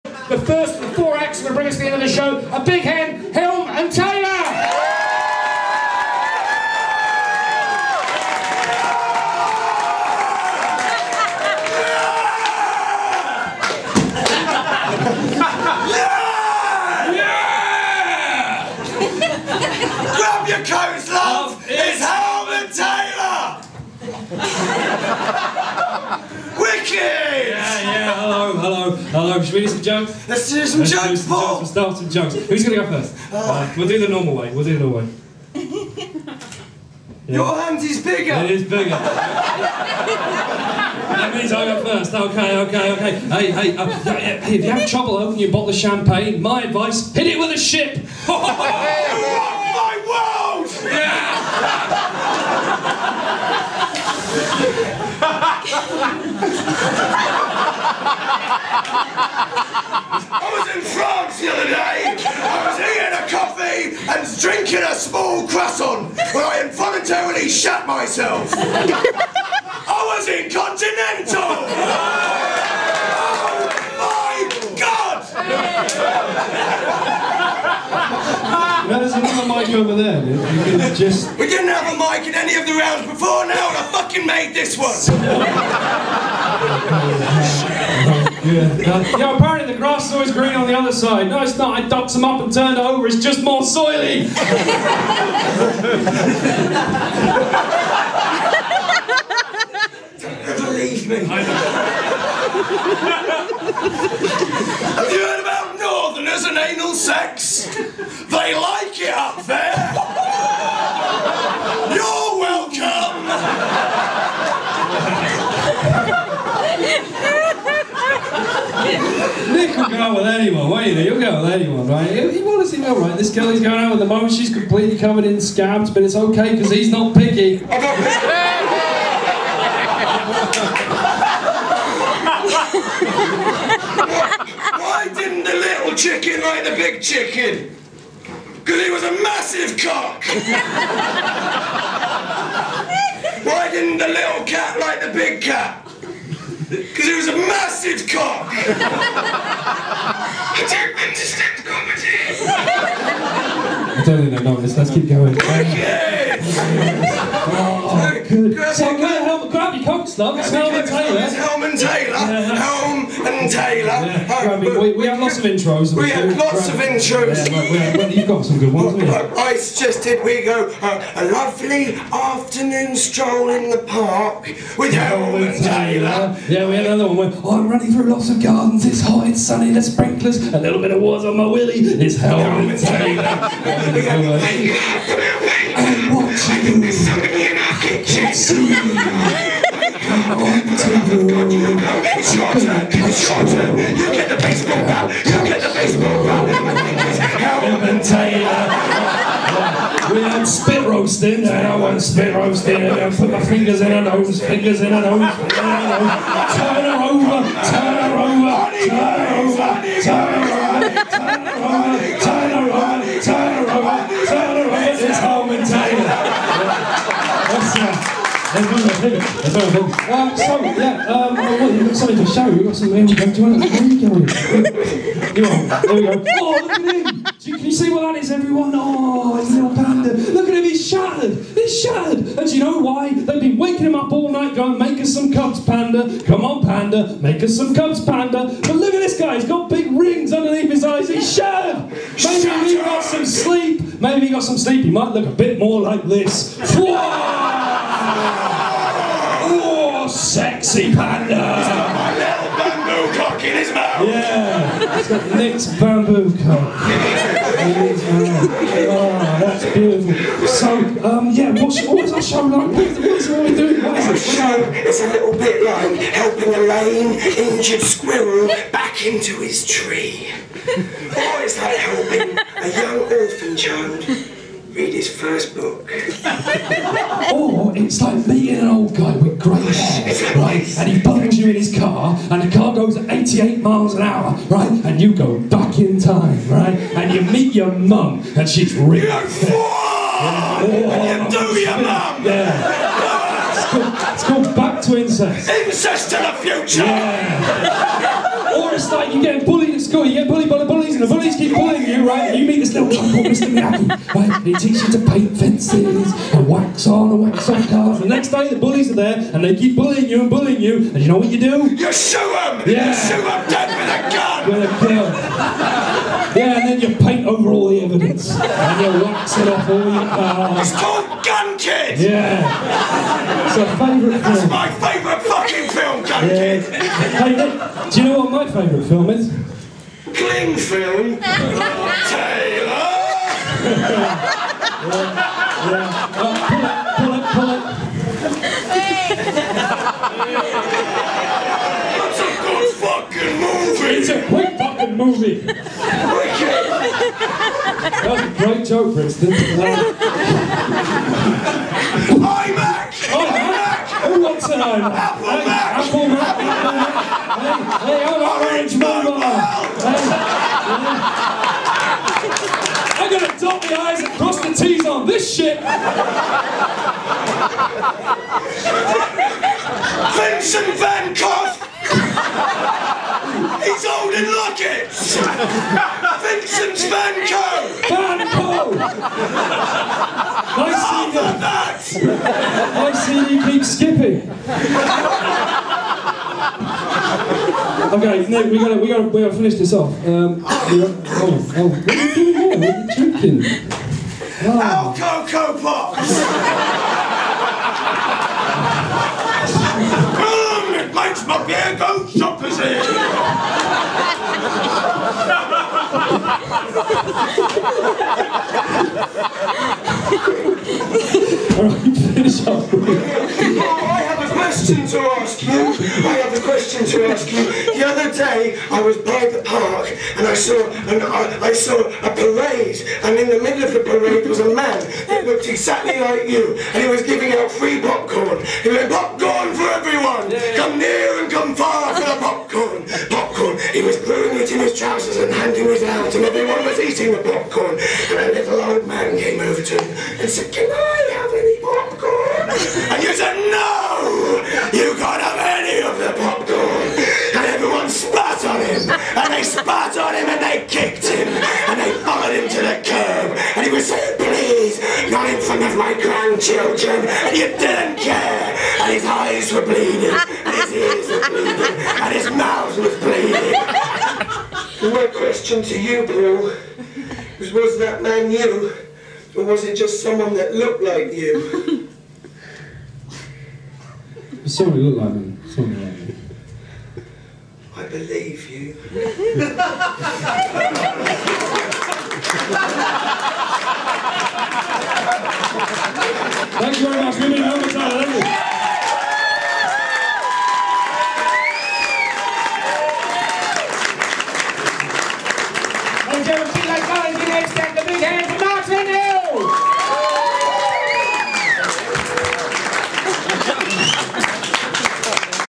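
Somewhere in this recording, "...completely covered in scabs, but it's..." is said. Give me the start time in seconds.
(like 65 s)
124 s.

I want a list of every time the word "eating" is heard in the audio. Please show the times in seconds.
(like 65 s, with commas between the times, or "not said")
62 s, 436 s.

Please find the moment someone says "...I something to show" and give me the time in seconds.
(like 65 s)
221 s.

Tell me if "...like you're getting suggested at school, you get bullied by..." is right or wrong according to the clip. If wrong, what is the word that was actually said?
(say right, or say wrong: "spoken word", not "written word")
wrong: "bullied", not "suggested".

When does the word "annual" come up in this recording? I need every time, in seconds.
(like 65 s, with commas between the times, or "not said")
not said.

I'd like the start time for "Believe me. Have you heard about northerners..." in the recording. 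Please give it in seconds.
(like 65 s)
100 s.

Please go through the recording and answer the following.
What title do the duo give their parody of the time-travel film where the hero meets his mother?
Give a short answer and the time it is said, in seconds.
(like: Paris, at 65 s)
Back to Incest, at 294 s.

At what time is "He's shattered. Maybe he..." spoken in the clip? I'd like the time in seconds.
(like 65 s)
241 s.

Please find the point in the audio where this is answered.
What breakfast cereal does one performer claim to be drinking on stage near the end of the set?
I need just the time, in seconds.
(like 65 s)
394 s.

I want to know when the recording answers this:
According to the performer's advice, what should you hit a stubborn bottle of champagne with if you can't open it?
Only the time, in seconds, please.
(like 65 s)
47 s.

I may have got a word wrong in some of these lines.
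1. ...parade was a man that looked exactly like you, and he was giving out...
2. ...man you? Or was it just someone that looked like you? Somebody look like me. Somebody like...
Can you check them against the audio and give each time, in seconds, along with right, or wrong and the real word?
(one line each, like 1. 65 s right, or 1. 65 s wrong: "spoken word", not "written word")
1. 423 s right
2. 468 s right.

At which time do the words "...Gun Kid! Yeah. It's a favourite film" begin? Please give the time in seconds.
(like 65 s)
321 s.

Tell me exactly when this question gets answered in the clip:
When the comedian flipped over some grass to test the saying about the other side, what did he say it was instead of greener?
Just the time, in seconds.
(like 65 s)
93 s.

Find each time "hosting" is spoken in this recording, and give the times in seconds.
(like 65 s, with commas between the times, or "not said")
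not said.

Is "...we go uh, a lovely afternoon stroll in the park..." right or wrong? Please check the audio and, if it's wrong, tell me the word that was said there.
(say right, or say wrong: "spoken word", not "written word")
right.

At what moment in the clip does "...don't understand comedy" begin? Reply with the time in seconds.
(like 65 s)
150 s.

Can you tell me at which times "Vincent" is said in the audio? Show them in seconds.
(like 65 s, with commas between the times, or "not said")
370 s, 376 s.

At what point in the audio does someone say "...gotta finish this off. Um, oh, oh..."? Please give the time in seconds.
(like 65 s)
389 s.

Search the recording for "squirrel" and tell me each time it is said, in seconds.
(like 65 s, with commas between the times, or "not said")
267 s.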